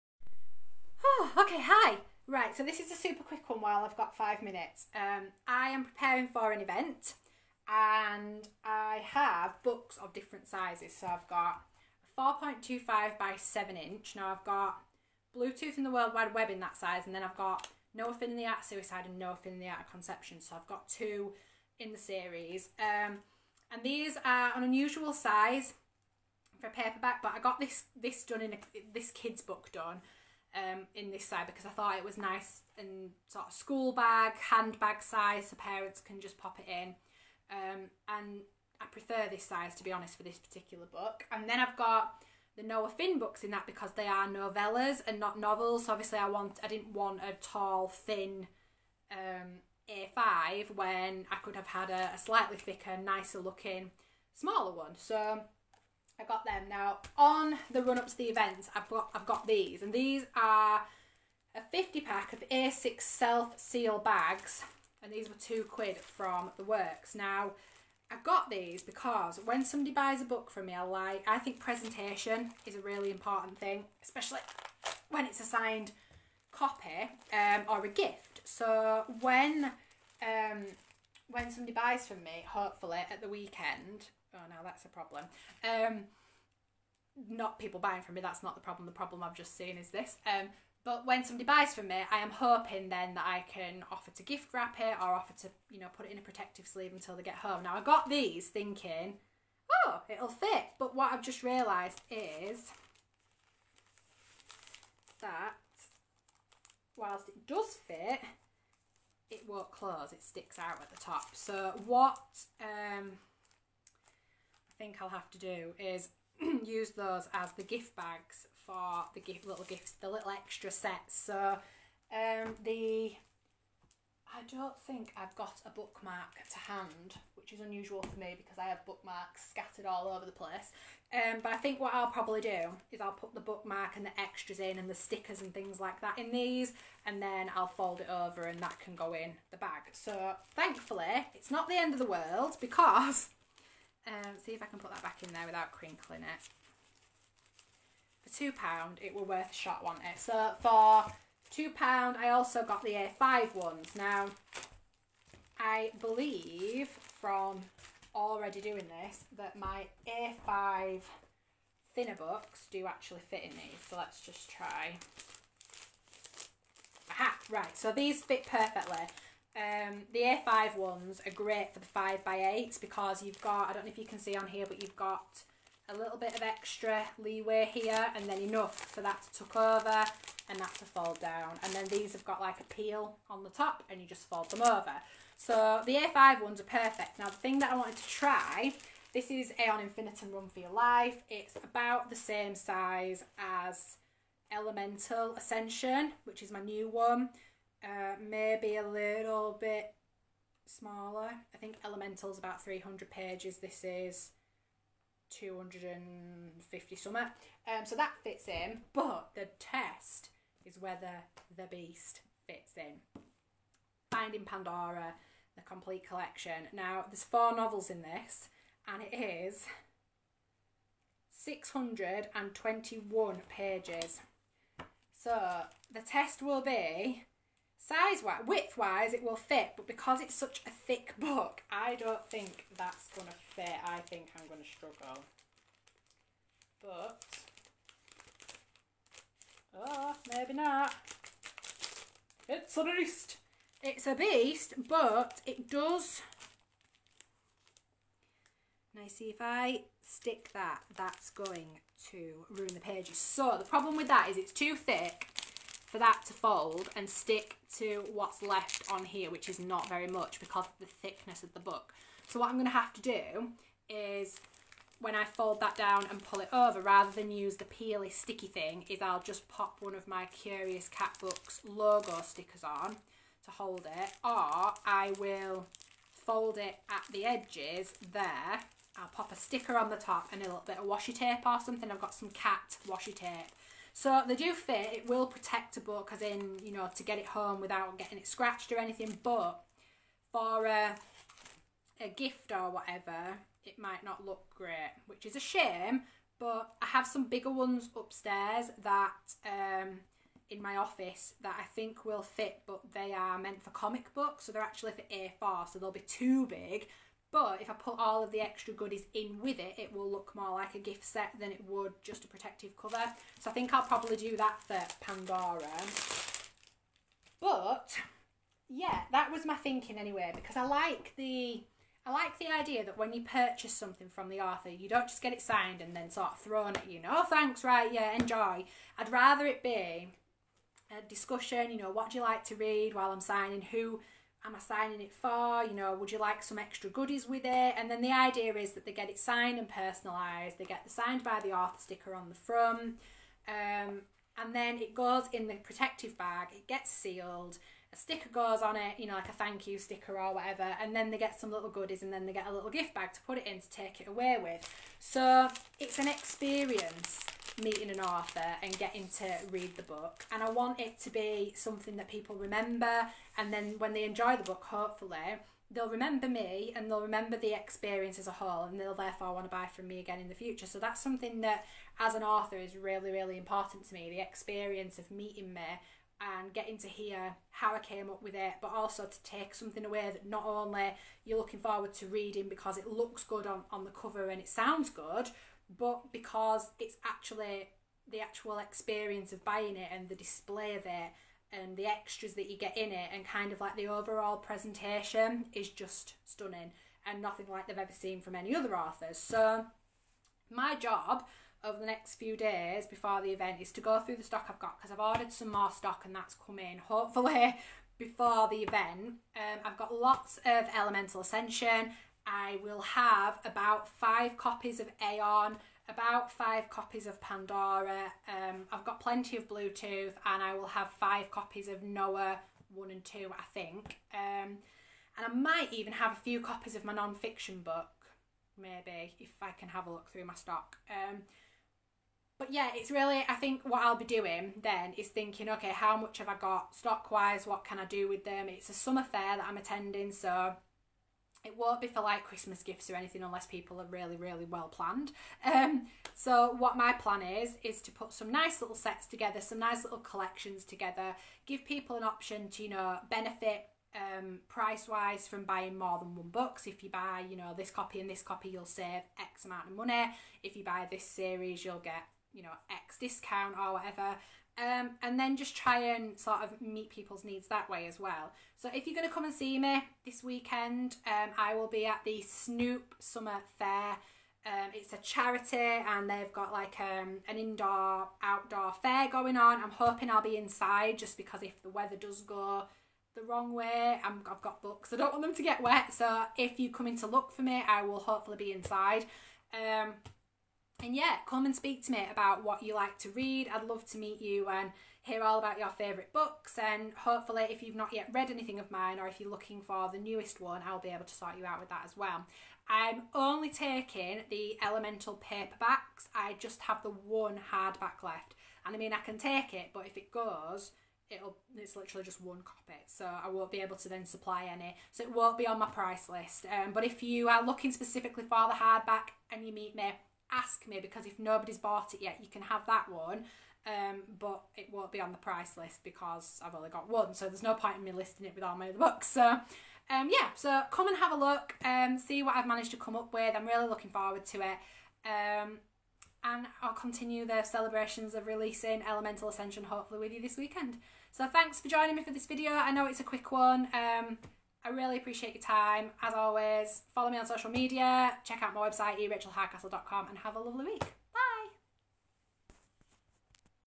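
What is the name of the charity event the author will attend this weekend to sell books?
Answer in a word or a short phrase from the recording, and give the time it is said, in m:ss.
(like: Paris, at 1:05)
Snoop Summer Fair, at 7:52.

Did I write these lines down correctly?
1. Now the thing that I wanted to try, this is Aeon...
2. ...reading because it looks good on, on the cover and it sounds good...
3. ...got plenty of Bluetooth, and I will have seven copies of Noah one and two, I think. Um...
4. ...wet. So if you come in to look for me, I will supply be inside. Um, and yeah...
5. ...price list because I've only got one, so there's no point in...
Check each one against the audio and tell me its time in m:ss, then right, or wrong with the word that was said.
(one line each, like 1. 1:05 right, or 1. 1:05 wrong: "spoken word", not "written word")
1. 3:07 right
2. 6:22 right
3. 6:58 wrong: "five", not "seven"
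4. 8:05 wrong: "hopefully", not "supply"
5. 8:45 right.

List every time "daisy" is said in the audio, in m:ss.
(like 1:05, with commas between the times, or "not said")
not said.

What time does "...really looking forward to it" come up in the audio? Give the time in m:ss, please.
8:53.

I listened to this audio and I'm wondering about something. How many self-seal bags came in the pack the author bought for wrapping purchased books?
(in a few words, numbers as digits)
50.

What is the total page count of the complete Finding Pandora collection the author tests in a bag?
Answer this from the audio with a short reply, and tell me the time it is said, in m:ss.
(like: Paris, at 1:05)
621, at 3:41.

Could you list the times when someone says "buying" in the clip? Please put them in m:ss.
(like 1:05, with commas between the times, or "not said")
1:27, 6:29, 7:35.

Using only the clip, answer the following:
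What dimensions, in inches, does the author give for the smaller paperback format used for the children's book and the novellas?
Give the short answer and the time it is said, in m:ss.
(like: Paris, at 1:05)
4.25 by 7 inch, at 0:12.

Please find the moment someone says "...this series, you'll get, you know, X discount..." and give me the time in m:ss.
7:40.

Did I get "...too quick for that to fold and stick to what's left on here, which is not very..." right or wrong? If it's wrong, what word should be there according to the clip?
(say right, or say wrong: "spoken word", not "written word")
wrong: "thick", not "quick".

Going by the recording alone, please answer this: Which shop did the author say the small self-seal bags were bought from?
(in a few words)
The Works.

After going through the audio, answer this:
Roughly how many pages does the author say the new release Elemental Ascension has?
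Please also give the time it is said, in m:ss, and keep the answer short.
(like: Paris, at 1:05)
300, at 3:22.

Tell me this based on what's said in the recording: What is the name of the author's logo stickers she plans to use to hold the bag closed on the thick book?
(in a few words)
Curious Cat Books.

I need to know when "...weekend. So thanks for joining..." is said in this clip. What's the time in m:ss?
9:00.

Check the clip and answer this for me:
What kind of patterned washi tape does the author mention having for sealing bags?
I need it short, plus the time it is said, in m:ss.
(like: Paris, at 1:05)
cat washi tape, at 4:42.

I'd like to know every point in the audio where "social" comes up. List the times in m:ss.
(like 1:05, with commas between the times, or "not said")
9:07.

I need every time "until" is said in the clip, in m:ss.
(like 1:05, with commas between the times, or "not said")
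1:36.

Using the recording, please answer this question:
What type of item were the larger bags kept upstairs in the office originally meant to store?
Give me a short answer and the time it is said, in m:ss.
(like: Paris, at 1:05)
comic books, at 5:03.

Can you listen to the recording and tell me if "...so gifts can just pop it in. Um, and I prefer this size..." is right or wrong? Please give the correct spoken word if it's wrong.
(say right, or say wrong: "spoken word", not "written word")
wrong: "parents", not "gifts".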